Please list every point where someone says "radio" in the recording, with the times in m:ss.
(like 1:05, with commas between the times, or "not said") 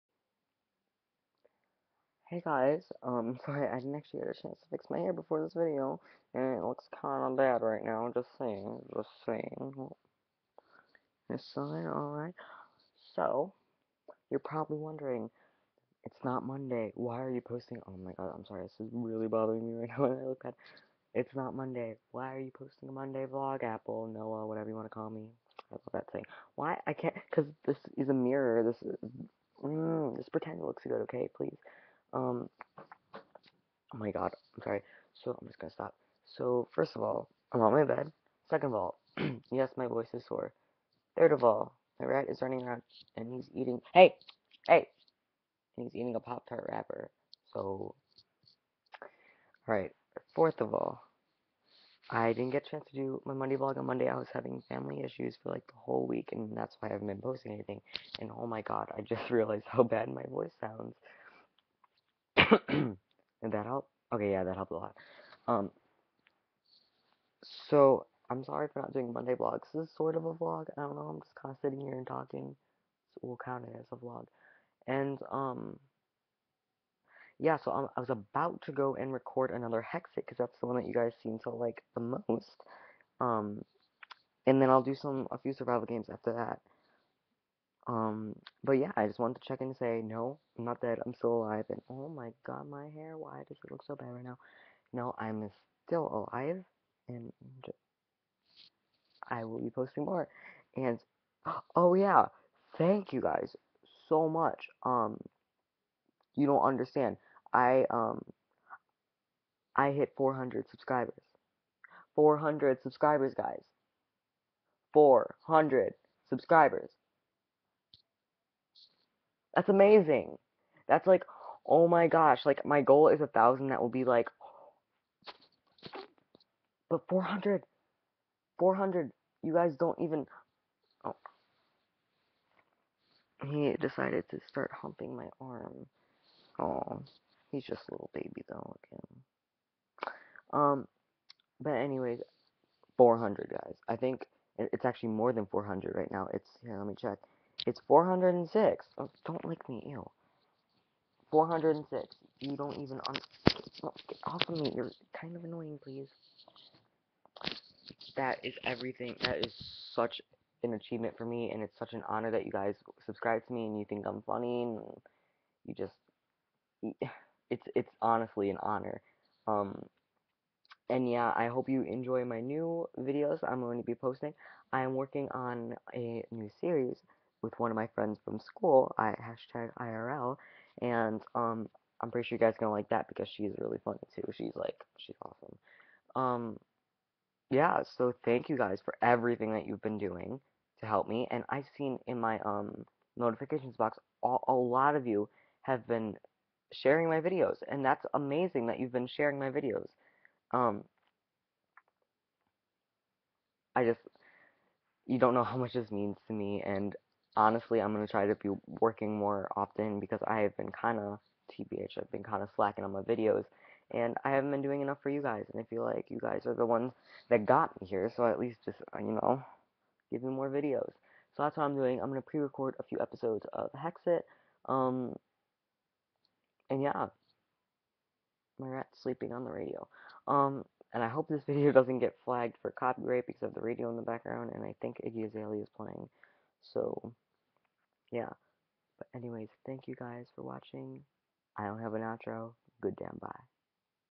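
3:49, 3:53.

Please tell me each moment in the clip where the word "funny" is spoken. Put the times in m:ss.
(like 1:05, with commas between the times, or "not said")
2:44, 3:03.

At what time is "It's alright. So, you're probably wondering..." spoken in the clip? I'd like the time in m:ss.
0:11.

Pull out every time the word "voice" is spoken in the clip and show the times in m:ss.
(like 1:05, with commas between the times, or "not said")
0:39, 1:00.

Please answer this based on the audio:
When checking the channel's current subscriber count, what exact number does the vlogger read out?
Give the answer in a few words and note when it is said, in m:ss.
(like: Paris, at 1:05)
406, at 2:27.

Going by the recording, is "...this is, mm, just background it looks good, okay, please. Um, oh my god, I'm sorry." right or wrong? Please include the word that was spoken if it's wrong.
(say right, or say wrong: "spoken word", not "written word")
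wrong: "pretend", not "background".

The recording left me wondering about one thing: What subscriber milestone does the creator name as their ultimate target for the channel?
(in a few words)
1000.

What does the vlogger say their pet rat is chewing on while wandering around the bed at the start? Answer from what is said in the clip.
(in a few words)
Pop Tart wrapper.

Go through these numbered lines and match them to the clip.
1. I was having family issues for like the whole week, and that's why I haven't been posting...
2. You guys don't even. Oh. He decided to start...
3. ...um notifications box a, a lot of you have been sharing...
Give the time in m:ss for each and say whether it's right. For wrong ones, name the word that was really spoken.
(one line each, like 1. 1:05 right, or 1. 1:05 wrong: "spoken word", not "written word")
1. 0:54 right
2. 2:09 right
3. 3:12 right.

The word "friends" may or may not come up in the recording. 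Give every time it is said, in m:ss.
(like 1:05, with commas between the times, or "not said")
2:57.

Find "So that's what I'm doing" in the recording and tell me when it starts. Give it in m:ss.
3:41.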